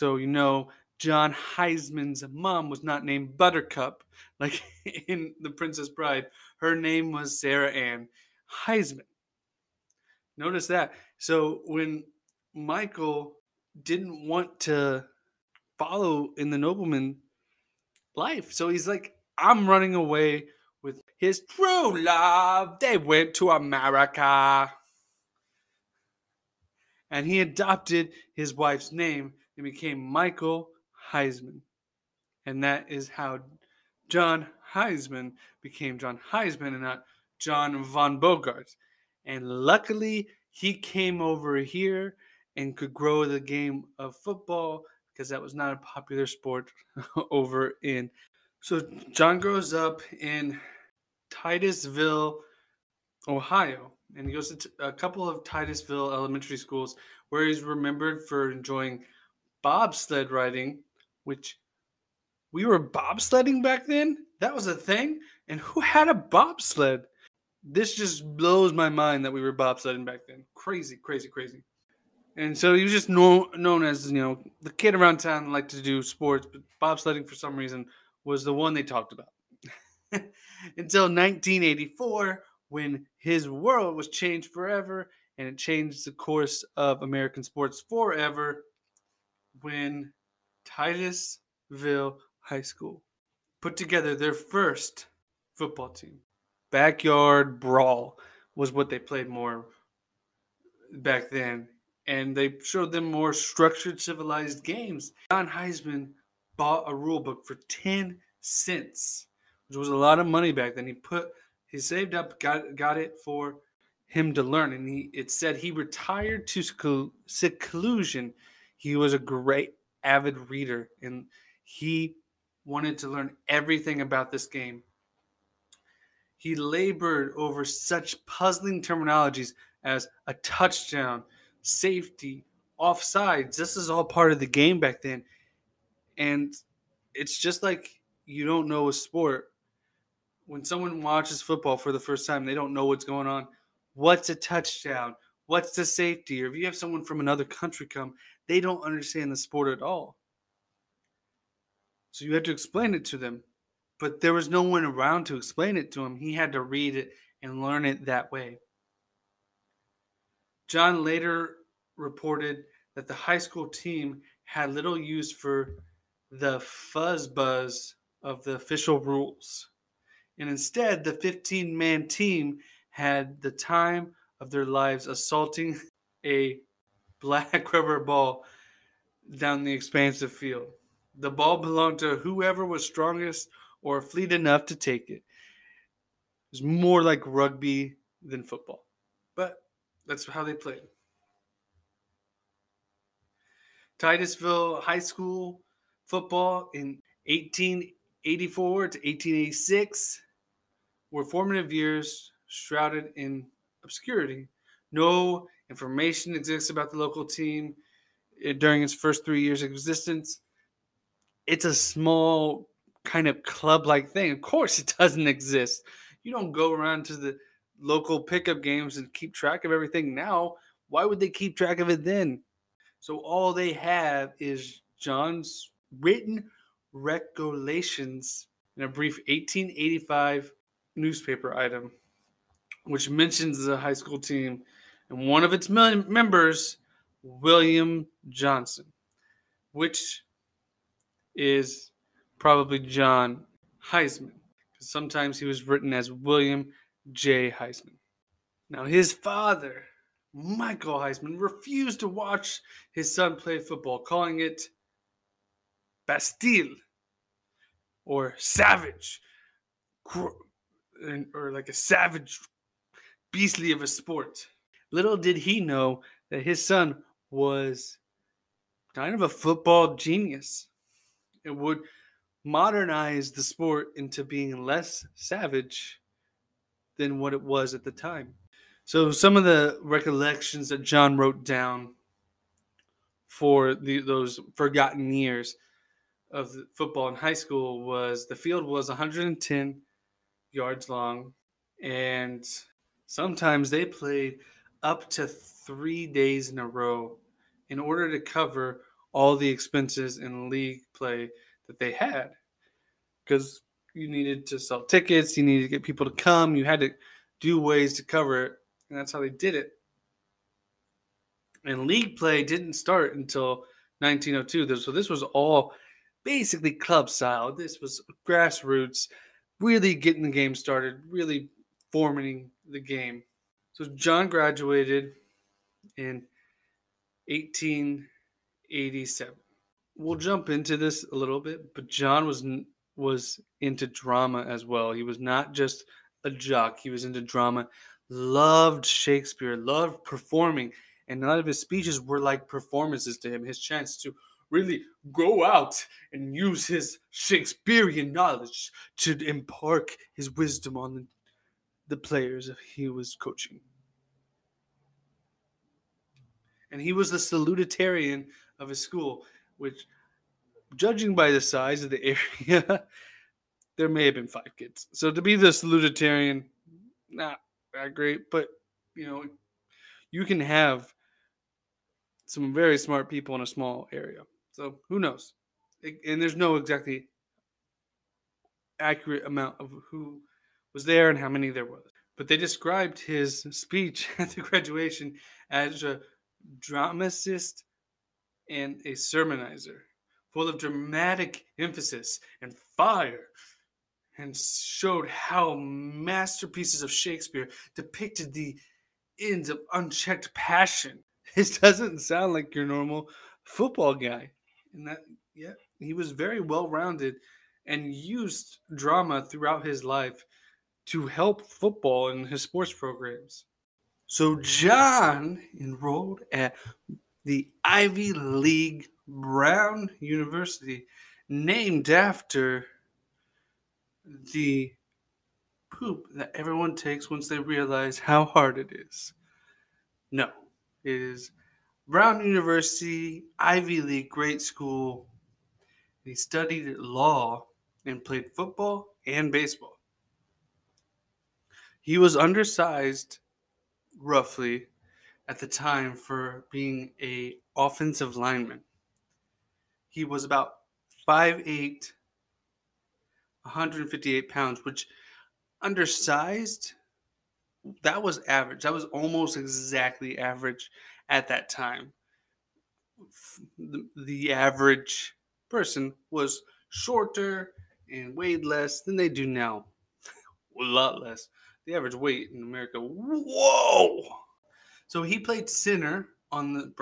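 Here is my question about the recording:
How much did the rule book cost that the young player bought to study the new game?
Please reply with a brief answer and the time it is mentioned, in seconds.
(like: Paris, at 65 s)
10 cents, at 107 s.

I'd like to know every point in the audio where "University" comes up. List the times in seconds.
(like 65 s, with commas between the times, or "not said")
419 s, 432 s.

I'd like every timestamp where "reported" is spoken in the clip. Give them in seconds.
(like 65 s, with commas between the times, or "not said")
161 s.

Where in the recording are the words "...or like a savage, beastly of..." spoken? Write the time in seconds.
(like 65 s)
261 s.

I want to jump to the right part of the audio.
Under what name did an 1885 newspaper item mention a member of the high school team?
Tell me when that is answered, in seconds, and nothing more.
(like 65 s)
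237 s.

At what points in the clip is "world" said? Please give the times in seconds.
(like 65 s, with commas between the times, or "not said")
83 s.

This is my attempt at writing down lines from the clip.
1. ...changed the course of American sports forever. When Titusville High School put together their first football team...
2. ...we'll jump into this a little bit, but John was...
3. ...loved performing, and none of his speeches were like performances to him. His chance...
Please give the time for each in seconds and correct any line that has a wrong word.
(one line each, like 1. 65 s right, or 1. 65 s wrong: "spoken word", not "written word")
1. 85 s right
2. 329 s right
3. 339 s right.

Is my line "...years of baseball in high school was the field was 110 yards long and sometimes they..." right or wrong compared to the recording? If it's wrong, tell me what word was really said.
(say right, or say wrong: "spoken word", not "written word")
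wrong: "football", not "baseball".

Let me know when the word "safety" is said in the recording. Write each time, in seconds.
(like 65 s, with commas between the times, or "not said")
131 s, 145 s.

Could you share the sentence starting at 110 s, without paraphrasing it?
He put he saved up, got got it for him to learn, and he it said he retired to seclusion.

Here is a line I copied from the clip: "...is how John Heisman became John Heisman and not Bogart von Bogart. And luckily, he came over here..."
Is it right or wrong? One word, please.
wrong.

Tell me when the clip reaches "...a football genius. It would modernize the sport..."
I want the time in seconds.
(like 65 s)
269 s.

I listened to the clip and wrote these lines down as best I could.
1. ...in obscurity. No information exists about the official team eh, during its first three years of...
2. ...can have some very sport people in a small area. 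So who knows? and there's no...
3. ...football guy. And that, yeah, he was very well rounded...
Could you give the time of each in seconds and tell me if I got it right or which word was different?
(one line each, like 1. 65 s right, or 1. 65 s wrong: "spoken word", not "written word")
1. 203 s wrong: "local", not "official"
2. 370 s wrong: "smart", not "sport"
3. 403 s right.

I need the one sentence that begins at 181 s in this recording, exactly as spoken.
The ball belonged to whoever was strongest or fleet enough to take it.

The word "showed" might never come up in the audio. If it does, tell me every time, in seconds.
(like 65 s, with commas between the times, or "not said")
102 s, 394 s.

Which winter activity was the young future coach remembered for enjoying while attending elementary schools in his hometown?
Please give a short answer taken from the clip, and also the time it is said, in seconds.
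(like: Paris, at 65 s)
Bobsled riding, at 59 s.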